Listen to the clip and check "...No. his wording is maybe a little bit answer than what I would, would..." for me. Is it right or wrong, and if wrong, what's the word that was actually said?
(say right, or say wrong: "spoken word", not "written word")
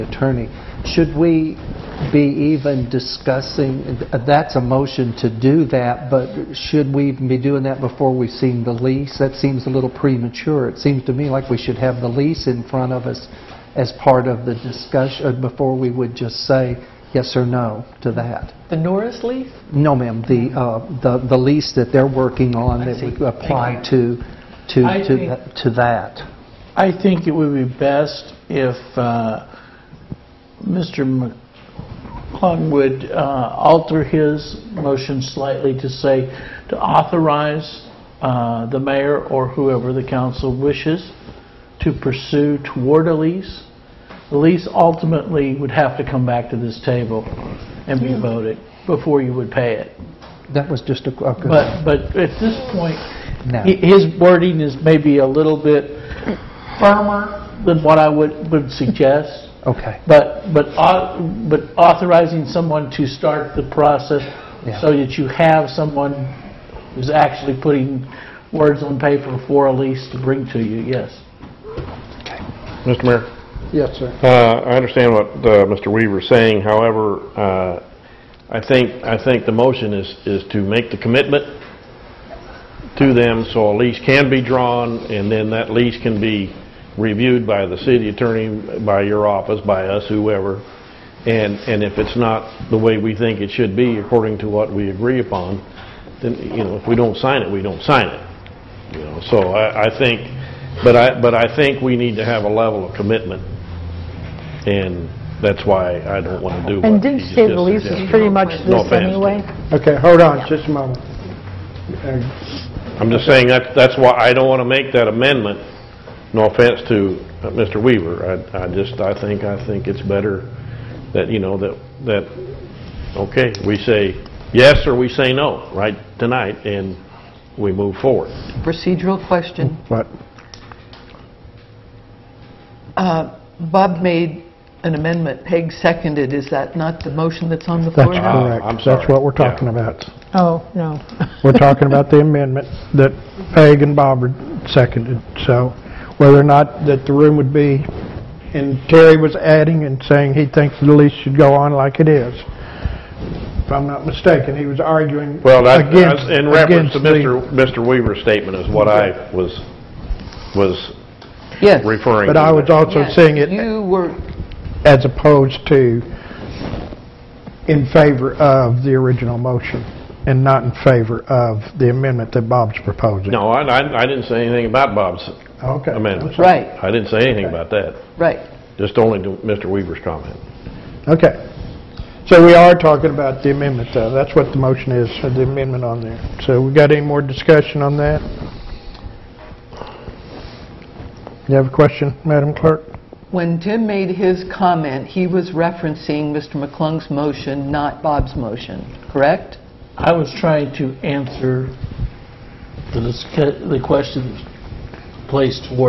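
wrong: "firmer", not "answer".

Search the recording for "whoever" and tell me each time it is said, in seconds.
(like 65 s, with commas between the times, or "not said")
39 s, 90 s.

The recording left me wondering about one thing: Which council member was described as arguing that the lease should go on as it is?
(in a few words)
Terry.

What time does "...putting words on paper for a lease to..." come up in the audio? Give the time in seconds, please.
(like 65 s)
67 s.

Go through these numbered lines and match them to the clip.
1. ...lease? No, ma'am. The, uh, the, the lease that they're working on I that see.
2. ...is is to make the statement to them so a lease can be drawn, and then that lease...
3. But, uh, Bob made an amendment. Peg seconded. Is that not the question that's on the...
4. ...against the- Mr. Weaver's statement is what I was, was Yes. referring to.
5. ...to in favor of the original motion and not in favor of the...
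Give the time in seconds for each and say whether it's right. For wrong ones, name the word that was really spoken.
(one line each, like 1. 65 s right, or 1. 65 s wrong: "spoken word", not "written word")
1. 19 s right
2. 79 s wrong: "commitment", not "statement"
3. 129 s wrong: "motion", not "question"
4. 156 s right
5. 165 s right.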